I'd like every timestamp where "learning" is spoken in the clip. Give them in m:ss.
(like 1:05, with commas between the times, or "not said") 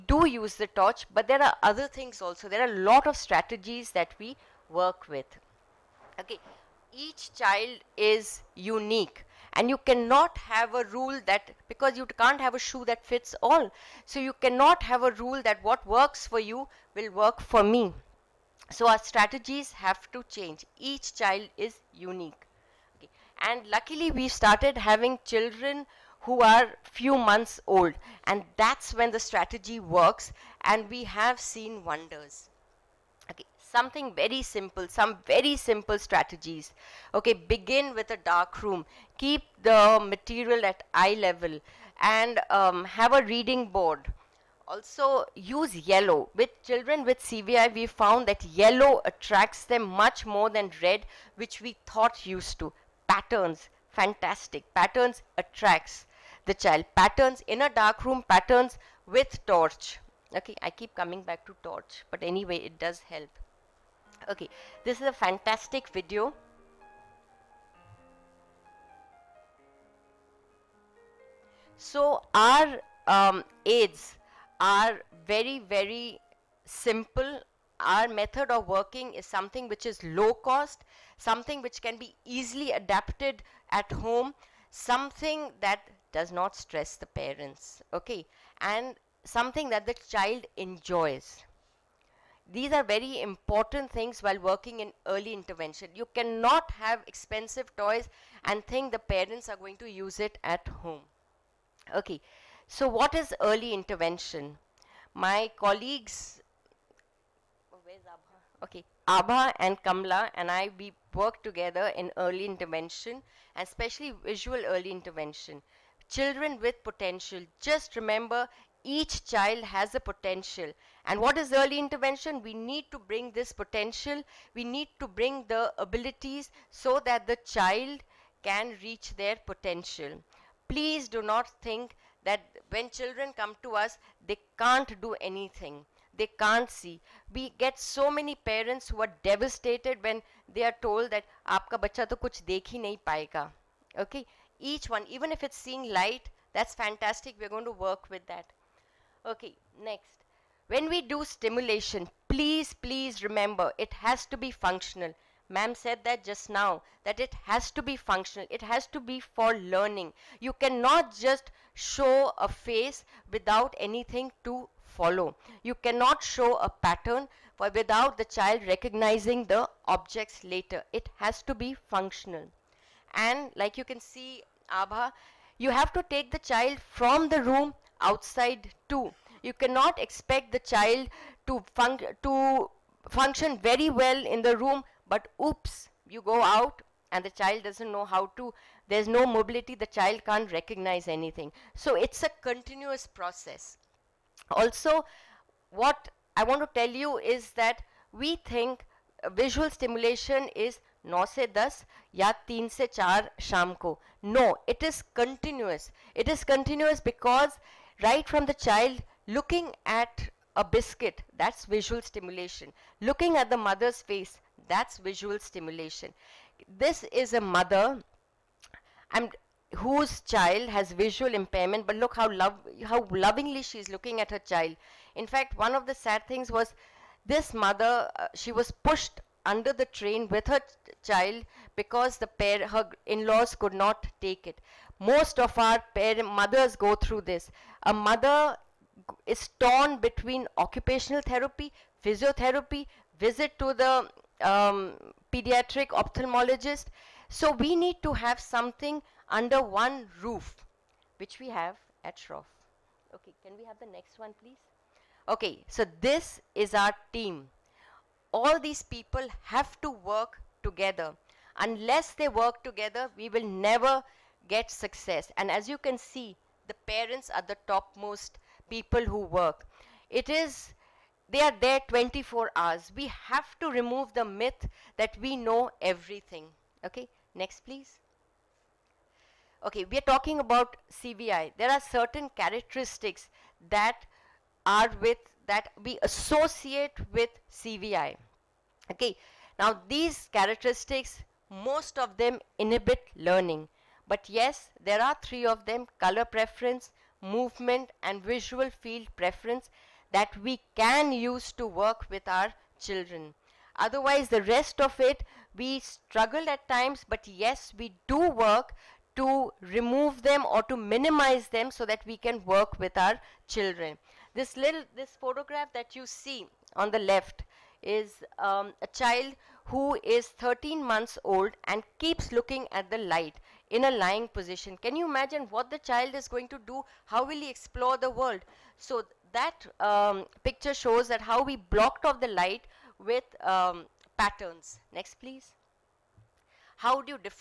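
2:39, 4:53.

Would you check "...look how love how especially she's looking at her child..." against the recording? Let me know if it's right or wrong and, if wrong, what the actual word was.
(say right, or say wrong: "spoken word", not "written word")
wrong: "lovingly", not "especially".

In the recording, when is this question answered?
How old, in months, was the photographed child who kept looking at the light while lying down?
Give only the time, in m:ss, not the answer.
5:20.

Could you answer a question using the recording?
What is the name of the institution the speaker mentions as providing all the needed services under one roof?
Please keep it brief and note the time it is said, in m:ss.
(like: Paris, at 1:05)
Shroff, at 4:12.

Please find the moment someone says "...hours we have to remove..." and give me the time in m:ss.
4:32.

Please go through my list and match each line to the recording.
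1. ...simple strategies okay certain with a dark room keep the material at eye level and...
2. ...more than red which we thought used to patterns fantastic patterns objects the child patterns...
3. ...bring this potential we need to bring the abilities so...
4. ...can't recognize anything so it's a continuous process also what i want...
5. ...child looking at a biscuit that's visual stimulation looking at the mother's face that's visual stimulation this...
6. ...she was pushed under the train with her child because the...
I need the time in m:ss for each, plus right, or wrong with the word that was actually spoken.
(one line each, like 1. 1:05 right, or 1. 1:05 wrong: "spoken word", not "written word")
1. 0:35 wrong: "begin", not "certain"
2. 0:50 wrong: "attracts", not "objects"
3. 2:02 right
4. 3:10 right
5. 3:28 right
6. 3:48 right.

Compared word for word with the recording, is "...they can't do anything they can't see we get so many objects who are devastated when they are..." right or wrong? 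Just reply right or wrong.
wrong.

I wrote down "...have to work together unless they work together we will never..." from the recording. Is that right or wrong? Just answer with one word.
right.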